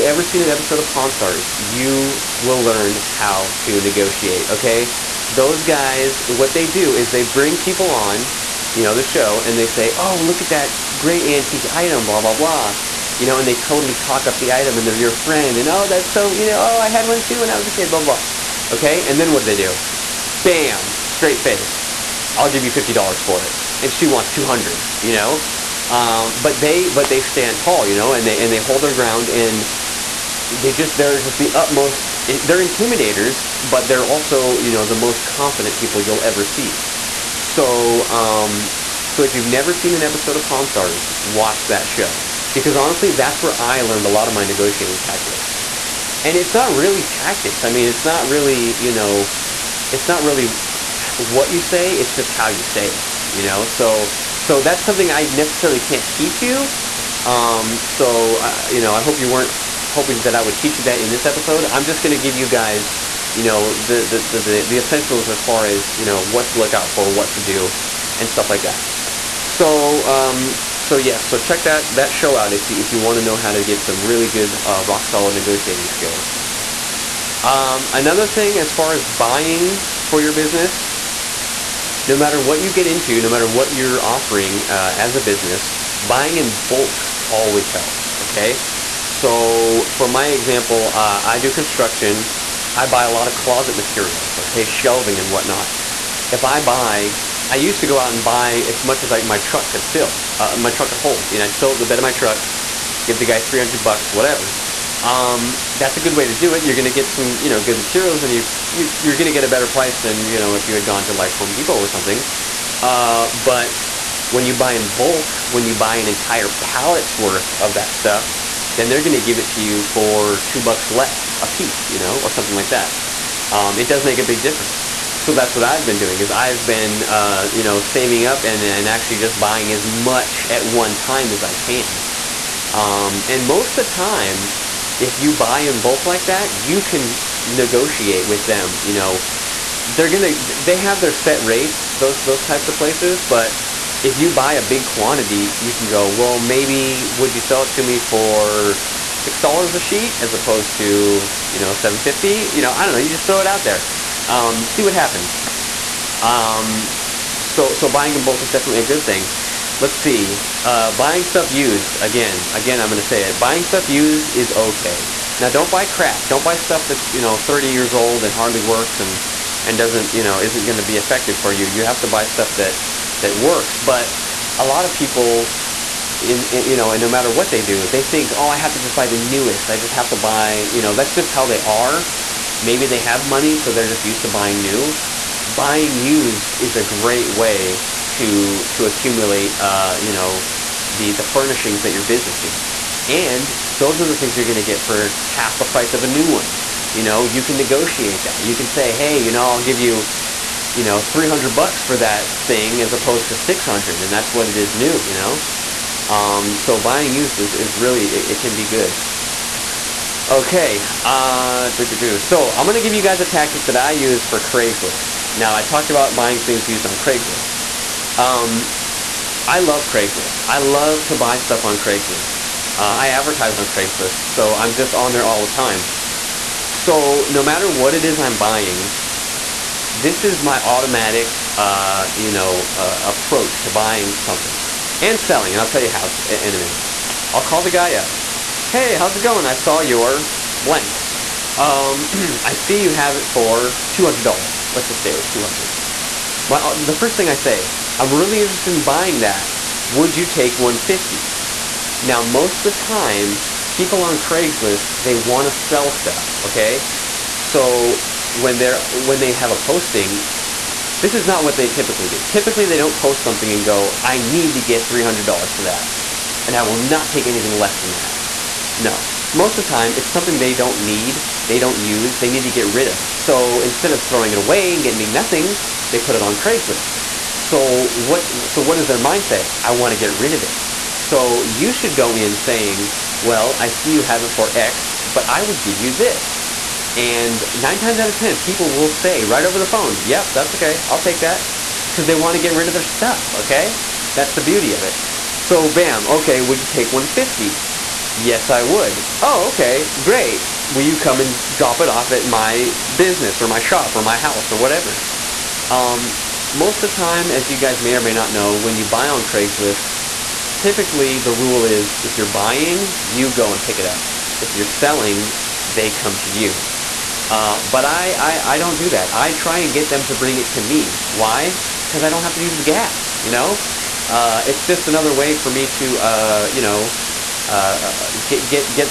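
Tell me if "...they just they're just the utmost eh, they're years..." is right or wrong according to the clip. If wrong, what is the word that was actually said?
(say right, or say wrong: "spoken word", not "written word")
wrong: "intimidators", not "years".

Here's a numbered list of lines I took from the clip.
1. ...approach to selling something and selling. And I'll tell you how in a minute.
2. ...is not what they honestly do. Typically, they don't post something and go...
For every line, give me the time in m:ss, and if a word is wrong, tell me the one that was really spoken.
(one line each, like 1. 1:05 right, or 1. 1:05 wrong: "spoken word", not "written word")
1. 3:53 wrong: "buying", not "selling"
2. 4:21 wrong: "typically", not "honestly".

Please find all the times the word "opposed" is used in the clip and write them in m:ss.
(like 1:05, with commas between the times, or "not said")
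2:30, 3:22.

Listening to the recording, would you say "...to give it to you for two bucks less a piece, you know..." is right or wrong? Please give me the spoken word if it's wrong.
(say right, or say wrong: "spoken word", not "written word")
right.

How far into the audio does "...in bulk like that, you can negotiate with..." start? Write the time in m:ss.
2:15.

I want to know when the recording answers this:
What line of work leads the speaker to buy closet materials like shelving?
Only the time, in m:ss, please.
1:31.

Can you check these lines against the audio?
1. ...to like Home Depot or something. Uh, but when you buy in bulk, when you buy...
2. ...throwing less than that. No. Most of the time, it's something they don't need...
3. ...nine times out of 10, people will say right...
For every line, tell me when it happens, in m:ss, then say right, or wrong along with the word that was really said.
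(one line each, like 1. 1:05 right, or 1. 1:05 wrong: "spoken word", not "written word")
1. 1:51 right
2. 4:27 wrong: "anything", not "throwing"
3. 4:47 right.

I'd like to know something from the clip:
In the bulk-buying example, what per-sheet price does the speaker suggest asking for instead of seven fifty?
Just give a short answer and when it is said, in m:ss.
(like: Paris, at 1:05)
$6, at 2:29.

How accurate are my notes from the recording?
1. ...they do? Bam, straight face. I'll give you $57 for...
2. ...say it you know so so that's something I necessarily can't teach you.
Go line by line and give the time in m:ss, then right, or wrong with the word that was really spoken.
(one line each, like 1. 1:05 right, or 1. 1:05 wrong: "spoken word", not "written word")
1. 0:19 wrong: "50", not "57"
2. 0:52 right.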